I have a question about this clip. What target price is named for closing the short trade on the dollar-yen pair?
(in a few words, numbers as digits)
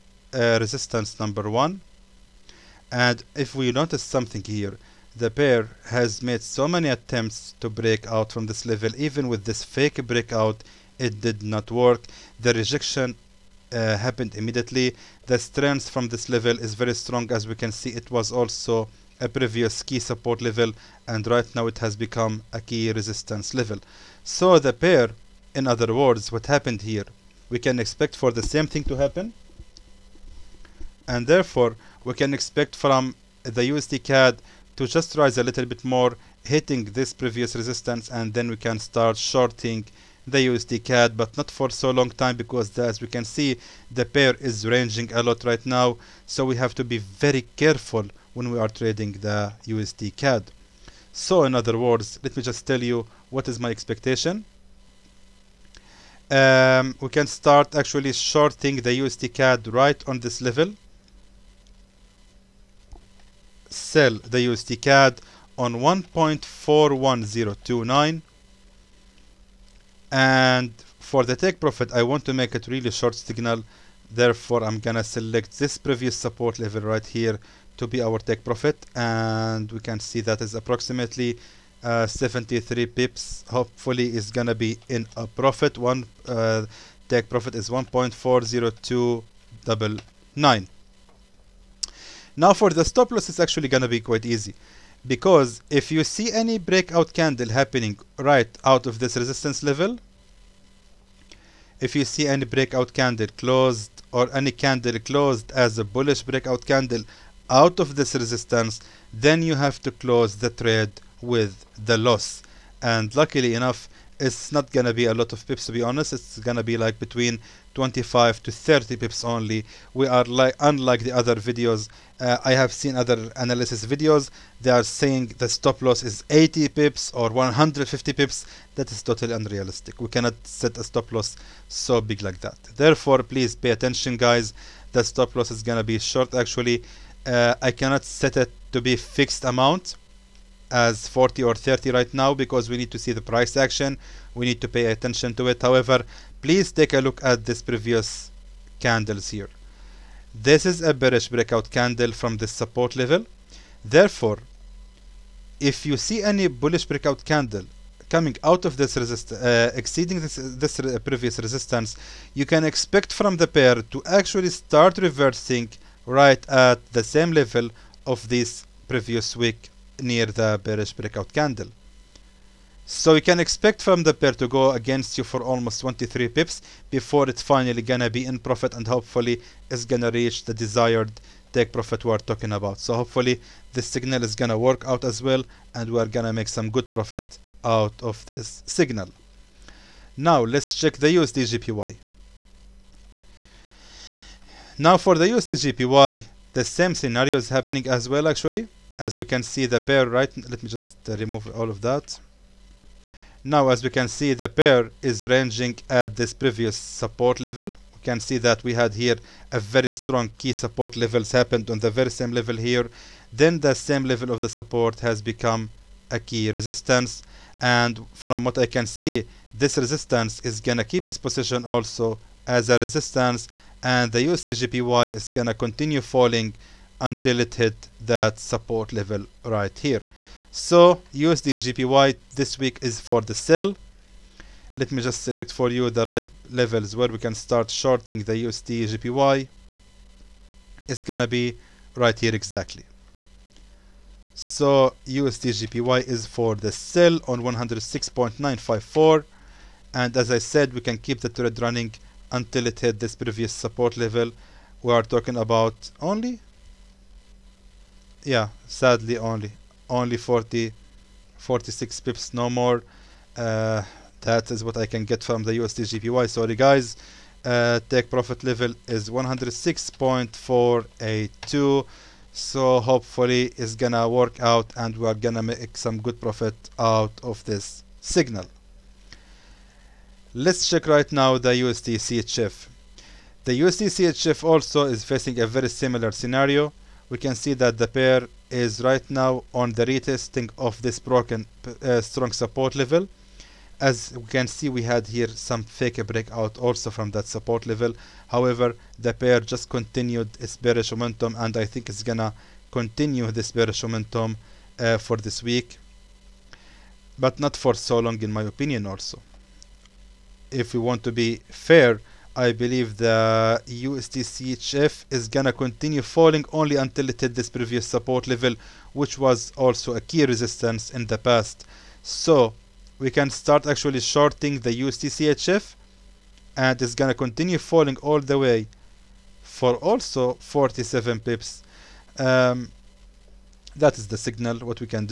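106.482.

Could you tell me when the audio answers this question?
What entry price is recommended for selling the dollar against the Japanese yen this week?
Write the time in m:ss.
4:07.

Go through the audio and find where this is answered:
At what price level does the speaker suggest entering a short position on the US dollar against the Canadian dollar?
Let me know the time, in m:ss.
1:05.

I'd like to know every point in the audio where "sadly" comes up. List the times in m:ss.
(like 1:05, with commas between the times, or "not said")
4:18.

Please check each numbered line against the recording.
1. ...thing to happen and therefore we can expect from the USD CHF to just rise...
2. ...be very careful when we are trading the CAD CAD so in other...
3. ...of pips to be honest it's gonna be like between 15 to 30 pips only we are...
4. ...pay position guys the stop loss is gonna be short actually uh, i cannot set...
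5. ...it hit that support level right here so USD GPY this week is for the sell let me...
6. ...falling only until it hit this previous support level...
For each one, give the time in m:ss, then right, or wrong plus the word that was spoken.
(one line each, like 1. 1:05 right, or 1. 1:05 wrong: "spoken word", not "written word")
1. 0:28 wrong: "CAD", not "CHF"
2. 0:46 wrong: "USD", not "CAD"
3. 1:55 wrong: "25", not "15"
4. 2:13 wrong: "attention", not "position"
5. 3:47 right
6. 5:16 right.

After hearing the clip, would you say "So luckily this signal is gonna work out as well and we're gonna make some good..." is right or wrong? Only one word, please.
wrong.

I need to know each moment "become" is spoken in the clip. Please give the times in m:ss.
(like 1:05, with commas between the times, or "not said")
0:21, 3:35.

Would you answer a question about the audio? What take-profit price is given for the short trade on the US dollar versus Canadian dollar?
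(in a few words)
1.40299.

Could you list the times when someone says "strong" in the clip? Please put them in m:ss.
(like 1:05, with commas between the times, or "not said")
0:16, 3:29, 4:52.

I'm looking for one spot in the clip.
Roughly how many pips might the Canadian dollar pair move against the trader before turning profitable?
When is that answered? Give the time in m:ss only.
2:55.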